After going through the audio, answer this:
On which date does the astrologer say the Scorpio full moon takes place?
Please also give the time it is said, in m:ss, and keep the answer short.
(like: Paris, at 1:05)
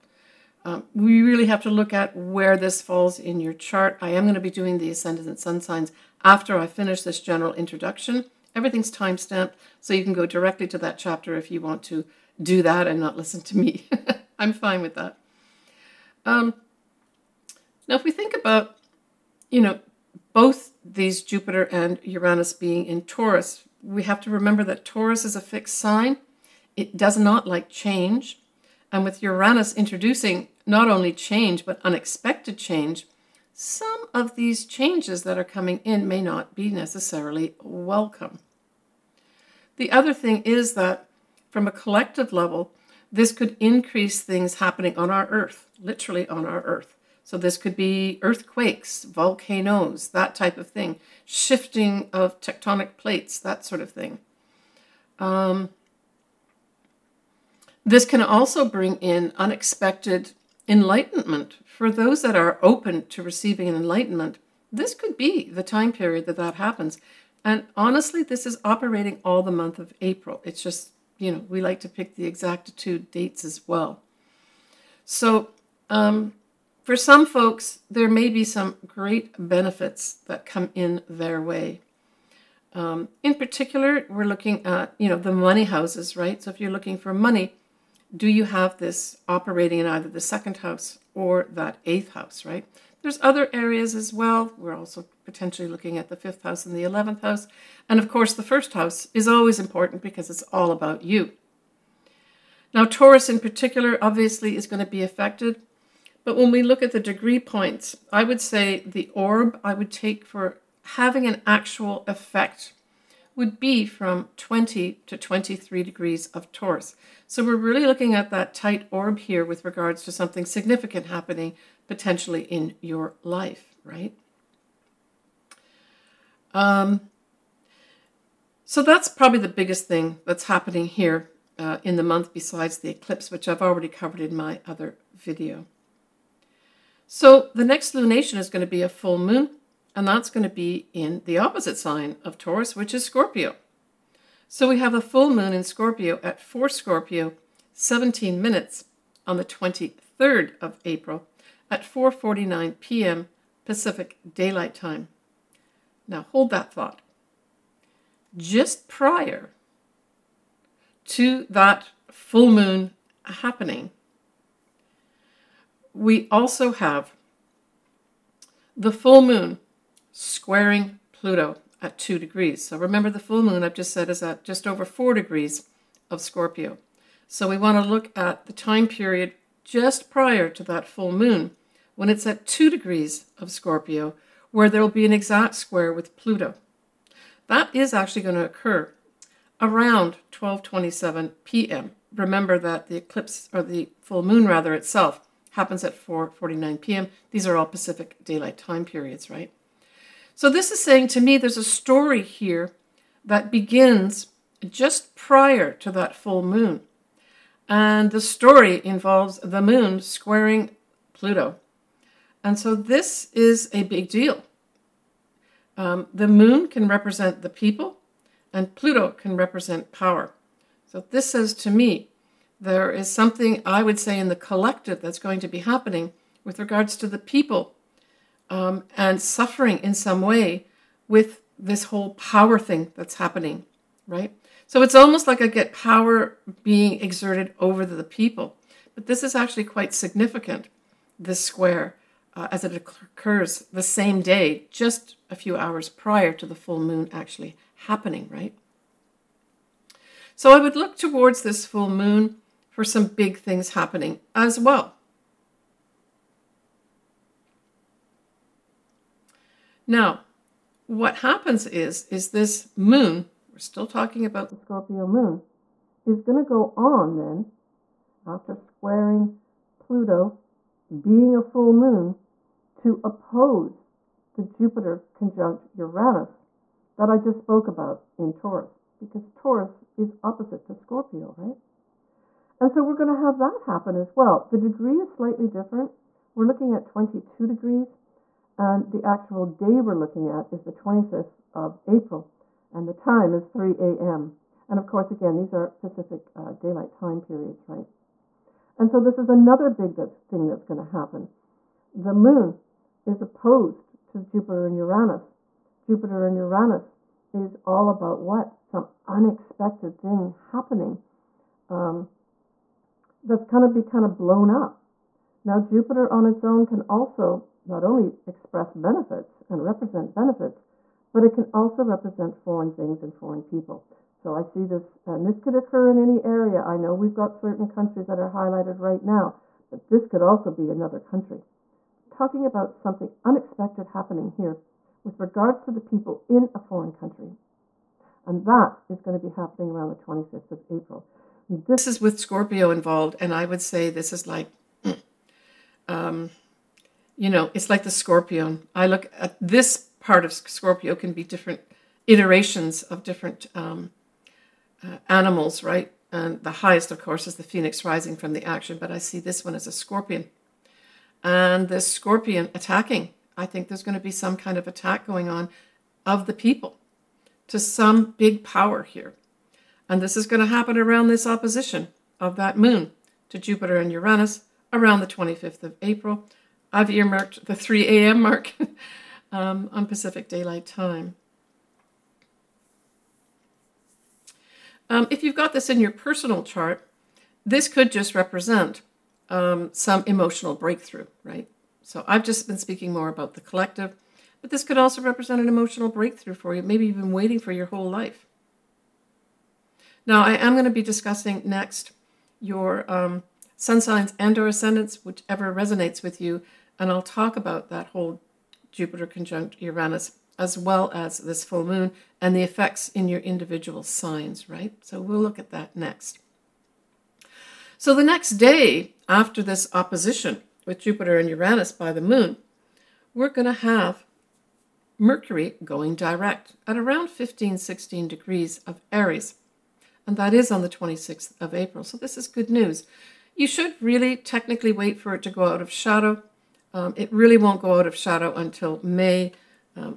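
23rd of April, at 2:29.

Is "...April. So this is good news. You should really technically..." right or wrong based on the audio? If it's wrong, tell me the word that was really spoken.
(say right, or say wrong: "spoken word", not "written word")
right.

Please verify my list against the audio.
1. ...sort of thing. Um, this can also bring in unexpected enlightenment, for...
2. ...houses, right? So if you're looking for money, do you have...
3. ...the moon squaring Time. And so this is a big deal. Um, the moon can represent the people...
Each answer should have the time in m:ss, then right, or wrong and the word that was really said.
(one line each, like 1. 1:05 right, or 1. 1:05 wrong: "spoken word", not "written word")
1. 0:53 right
2. 1:25 right
3. 3:29 wrong: "Pluto", not "Time".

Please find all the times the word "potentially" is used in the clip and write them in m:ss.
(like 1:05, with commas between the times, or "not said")
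1:35, 2:01.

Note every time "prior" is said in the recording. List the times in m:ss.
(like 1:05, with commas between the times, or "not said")
2:38, 3:00, 3:25, 4:05.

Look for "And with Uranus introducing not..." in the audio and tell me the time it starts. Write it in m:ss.
0:28.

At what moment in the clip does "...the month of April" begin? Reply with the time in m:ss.
1:09.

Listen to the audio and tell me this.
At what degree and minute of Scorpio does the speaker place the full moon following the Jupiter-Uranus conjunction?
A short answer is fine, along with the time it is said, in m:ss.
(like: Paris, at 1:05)
4 Scorpio, 17 minutes, at 2:26.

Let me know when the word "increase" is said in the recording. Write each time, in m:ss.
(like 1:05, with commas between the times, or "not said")
0:43.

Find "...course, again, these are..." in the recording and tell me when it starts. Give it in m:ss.
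4:54.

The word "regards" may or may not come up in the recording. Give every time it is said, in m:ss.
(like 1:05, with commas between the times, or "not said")
1:59, 3:46, 5:35.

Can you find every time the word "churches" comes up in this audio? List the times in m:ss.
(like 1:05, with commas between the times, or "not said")
not said.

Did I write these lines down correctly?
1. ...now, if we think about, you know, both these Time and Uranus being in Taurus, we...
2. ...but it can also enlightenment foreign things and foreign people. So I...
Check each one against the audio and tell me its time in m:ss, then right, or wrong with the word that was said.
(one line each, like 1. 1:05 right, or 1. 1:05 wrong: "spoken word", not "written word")
1. 0:17 wrong: "Jupiter", not "Time"
2. 5:21 wrong: "represent", not "enlightenment".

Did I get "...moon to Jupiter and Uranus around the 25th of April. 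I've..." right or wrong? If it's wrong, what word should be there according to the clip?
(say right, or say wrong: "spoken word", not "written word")
right.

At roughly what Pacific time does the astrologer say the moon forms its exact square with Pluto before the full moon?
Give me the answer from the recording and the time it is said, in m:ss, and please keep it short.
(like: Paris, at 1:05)
12:27 p.m., at 3:10.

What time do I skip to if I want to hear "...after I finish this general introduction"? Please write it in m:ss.
0:06.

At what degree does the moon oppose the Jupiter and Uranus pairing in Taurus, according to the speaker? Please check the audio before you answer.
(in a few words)
22 degrees.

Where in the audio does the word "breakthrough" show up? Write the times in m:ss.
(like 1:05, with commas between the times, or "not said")
6:30, 6:35.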